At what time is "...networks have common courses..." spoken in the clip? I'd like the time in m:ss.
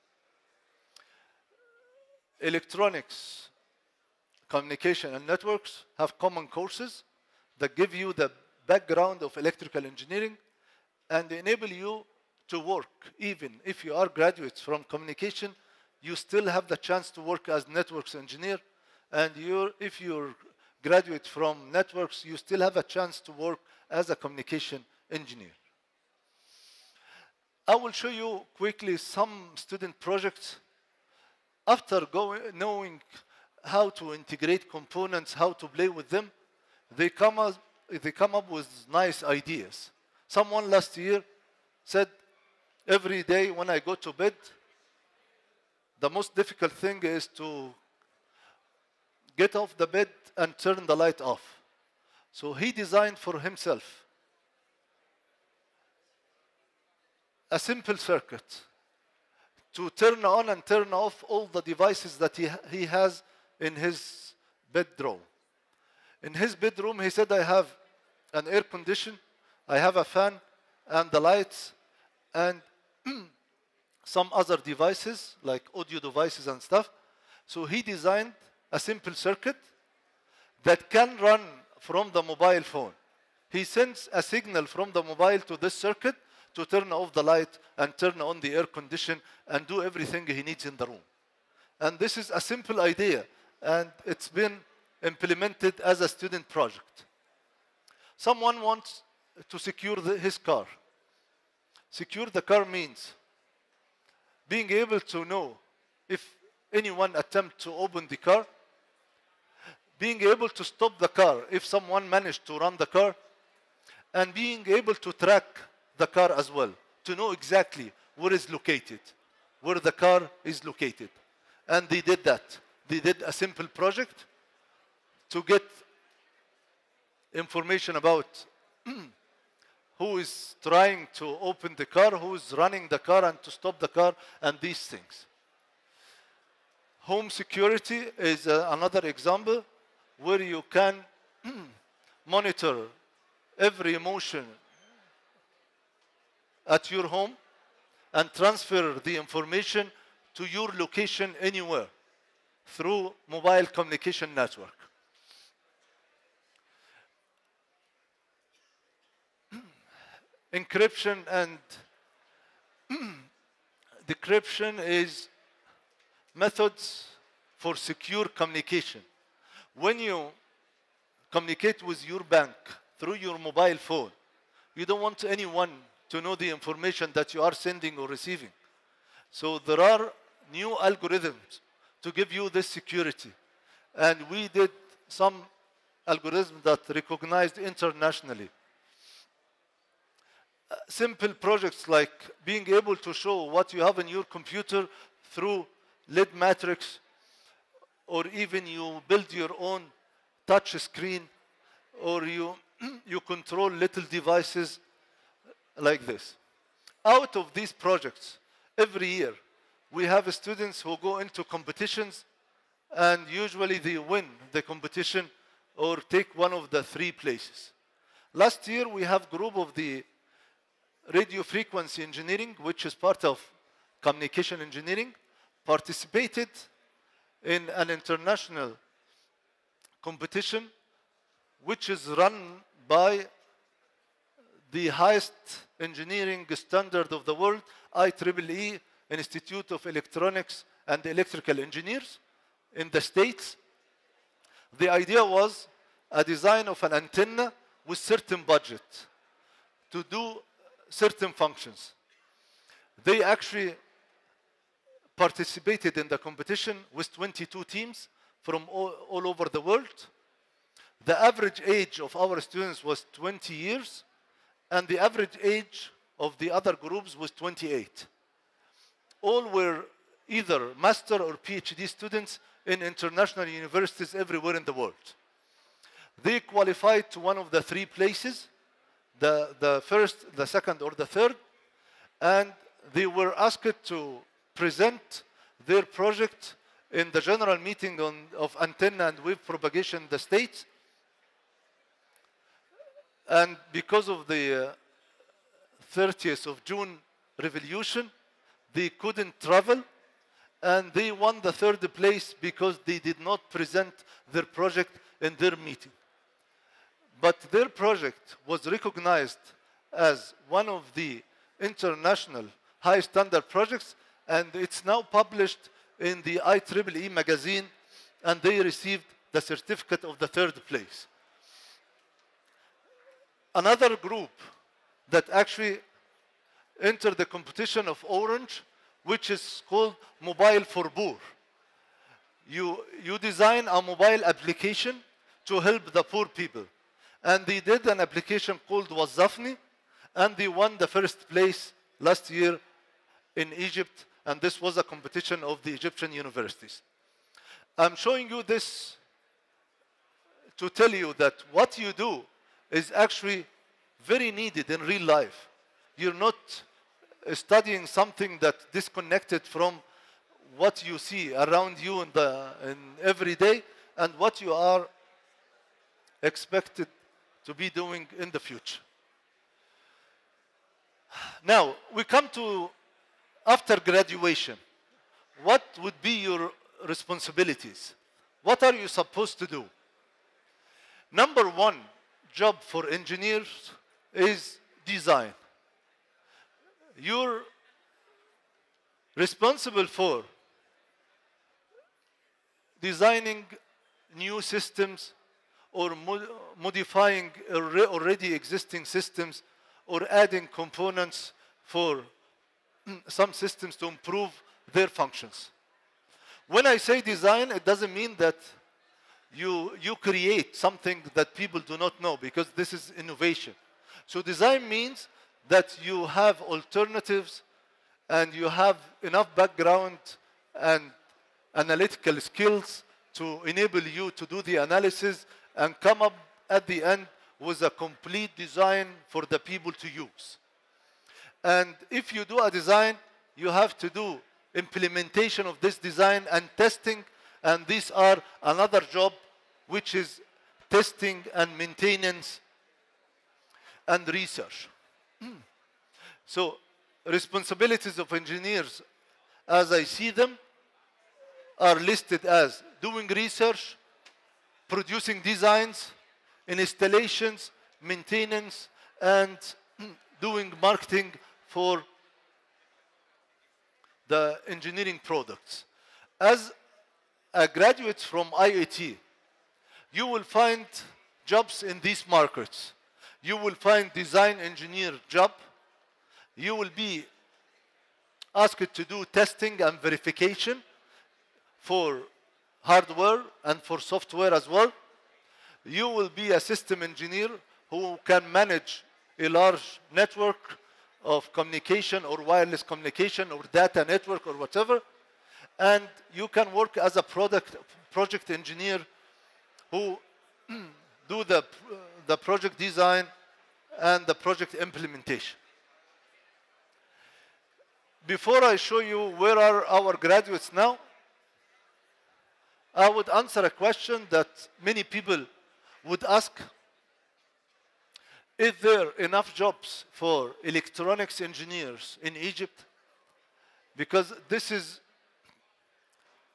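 0:05.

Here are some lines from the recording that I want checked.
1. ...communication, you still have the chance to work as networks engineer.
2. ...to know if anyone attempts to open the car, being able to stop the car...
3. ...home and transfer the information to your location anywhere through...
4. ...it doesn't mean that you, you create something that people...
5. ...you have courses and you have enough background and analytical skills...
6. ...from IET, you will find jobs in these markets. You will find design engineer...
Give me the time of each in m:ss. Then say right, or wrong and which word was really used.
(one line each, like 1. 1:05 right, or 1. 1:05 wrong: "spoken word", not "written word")
1. 0:14 right
2. 1:44 right
3. 2:27 right
4. 6:47 right
5. 6:55 wrong: "alternatives", not "courses"
6. 7:48 right.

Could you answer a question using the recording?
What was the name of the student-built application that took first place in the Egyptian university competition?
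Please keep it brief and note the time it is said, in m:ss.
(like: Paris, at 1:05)
Wazafni, at 5:38.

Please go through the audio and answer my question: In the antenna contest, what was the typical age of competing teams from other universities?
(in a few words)
28.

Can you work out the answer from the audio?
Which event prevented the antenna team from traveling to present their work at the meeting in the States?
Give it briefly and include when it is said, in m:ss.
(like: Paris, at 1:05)
30th of June revolution, at 4:55.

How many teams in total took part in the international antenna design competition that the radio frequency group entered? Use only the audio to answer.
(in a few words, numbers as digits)
22.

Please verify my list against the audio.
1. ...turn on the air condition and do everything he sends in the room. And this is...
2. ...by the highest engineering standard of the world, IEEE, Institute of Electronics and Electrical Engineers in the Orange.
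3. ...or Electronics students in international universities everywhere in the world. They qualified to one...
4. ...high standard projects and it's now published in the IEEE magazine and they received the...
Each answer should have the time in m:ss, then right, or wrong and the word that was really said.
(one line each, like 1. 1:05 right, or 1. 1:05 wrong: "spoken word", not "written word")
1. 1:27 wrong: "needs", not "sends"
2. 3:52 wrong: "States", not "Orange"
3. 4:31 wrong: "PhD", not "Electronics"
4. 5:12 right.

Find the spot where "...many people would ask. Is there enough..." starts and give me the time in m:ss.
8:34.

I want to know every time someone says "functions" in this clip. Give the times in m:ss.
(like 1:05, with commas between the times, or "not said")
4:11, 6:44.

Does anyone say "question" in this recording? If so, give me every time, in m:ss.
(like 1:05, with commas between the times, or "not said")
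8:33.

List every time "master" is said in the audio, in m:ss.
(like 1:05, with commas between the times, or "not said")
4:30.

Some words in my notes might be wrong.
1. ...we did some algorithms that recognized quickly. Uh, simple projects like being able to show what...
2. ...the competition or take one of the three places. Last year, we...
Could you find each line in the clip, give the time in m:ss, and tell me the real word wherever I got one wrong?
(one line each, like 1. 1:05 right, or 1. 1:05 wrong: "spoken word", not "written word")
1. 3:04 wrong: "internationally", not "quickly"
2. 3:34 right.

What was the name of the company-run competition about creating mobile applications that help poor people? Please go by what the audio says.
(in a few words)
Mobile for Poor.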